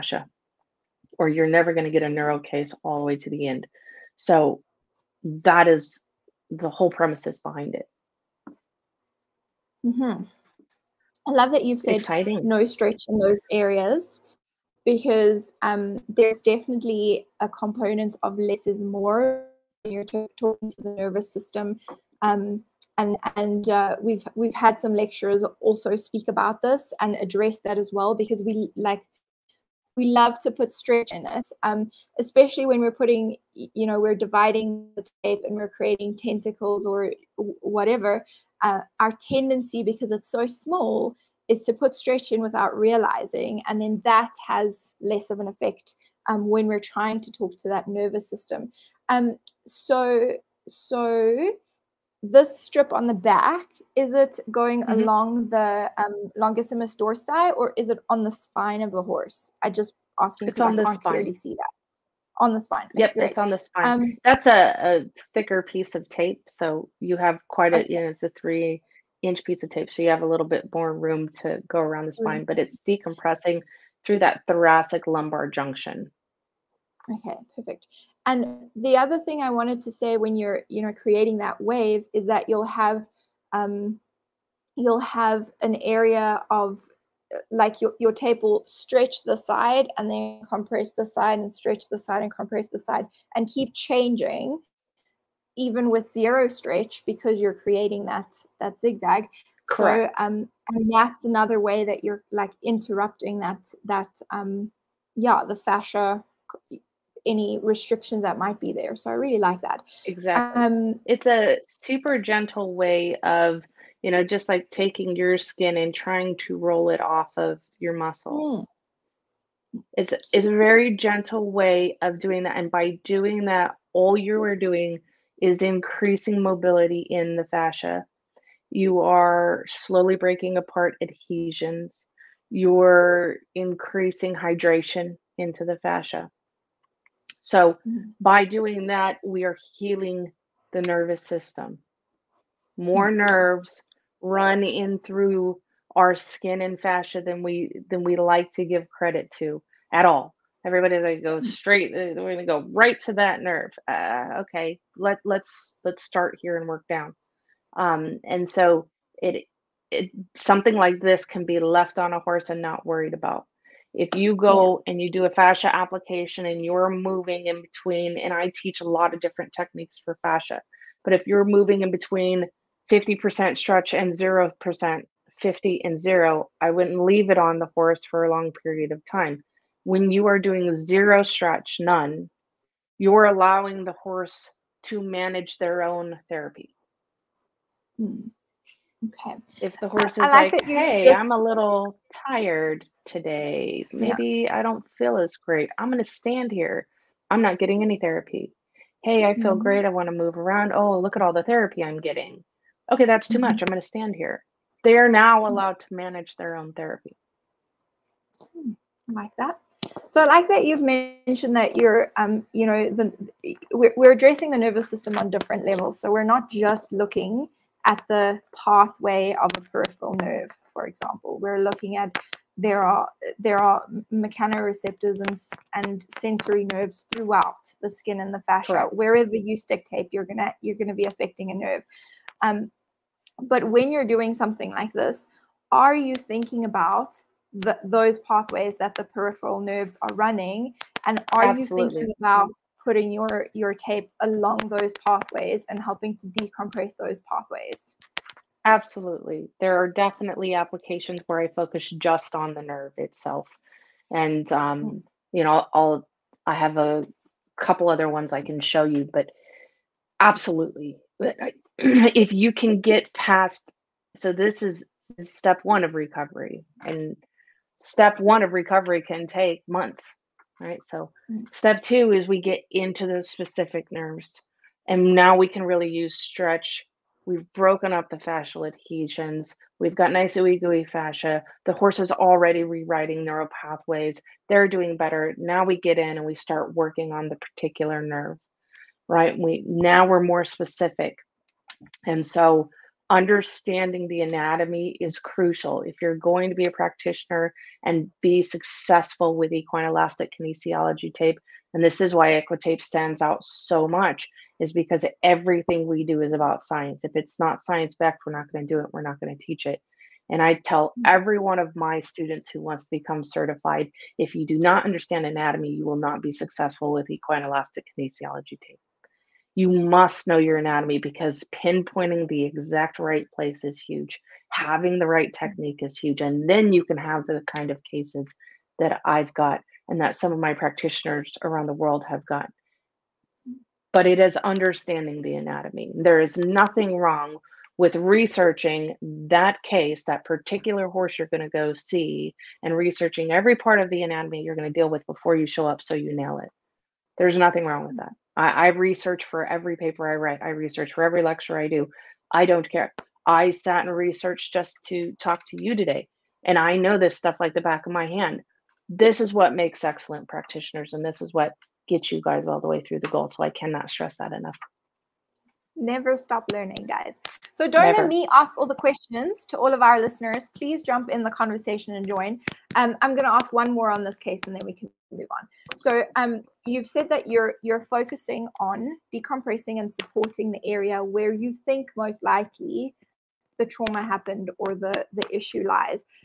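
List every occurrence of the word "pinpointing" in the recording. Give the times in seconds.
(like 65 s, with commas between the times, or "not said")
321 s.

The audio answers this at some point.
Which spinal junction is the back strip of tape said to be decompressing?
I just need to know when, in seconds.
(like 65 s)
74 s.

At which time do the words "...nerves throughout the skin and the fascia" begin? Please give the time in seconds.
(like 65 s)
226 s.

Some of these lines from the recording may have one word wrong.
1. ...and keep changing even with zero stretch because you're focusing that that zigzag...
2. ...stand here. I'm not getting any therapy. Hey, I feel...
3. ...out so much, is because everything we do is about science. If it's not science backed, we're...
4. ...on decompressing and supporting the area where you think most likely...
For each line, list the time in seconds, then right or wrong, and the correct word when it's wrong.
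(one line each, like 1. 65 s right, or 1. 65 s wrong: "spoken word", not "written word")
1. 93 s wrong: "creating", not "focusing"
2. 196 s right
3. 303 s right
4. 378 s right.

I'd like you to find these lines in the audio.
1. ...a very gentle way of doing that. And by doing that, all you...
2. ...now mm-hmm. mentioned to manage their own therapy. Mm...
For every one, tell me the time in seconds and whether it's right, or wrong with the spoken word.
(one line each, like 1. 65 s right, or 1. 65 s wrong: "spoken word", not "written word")
1. 120 s right
2. 205 s wrong: "allowed", not "mentioned".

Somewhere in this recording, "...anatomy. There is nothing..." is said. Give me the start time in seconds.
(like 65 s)
335 s.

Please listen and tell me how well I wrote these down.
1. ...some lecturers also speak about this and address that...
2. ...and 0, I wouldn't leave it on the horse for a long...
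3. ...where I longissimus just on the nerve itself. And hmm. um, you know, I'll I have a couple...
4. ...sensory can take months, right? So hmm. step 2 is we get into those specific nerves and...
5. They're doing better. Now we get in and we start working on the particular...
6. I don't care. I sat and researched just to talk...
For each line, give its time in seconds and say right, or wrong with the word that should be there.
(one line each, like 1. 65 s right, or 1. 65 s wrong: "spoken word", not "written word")
1. 24 s right
2. 175 s right
3. 251 s wrong: "focus", not "longissimus"
4. 268 s wrong: "recovery", not "sensory"
5. 284 s right
6. 352 s right.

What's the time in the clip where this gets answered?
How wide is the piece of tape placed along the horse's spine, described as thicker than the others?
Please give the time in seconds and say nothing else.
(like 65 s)
68 s.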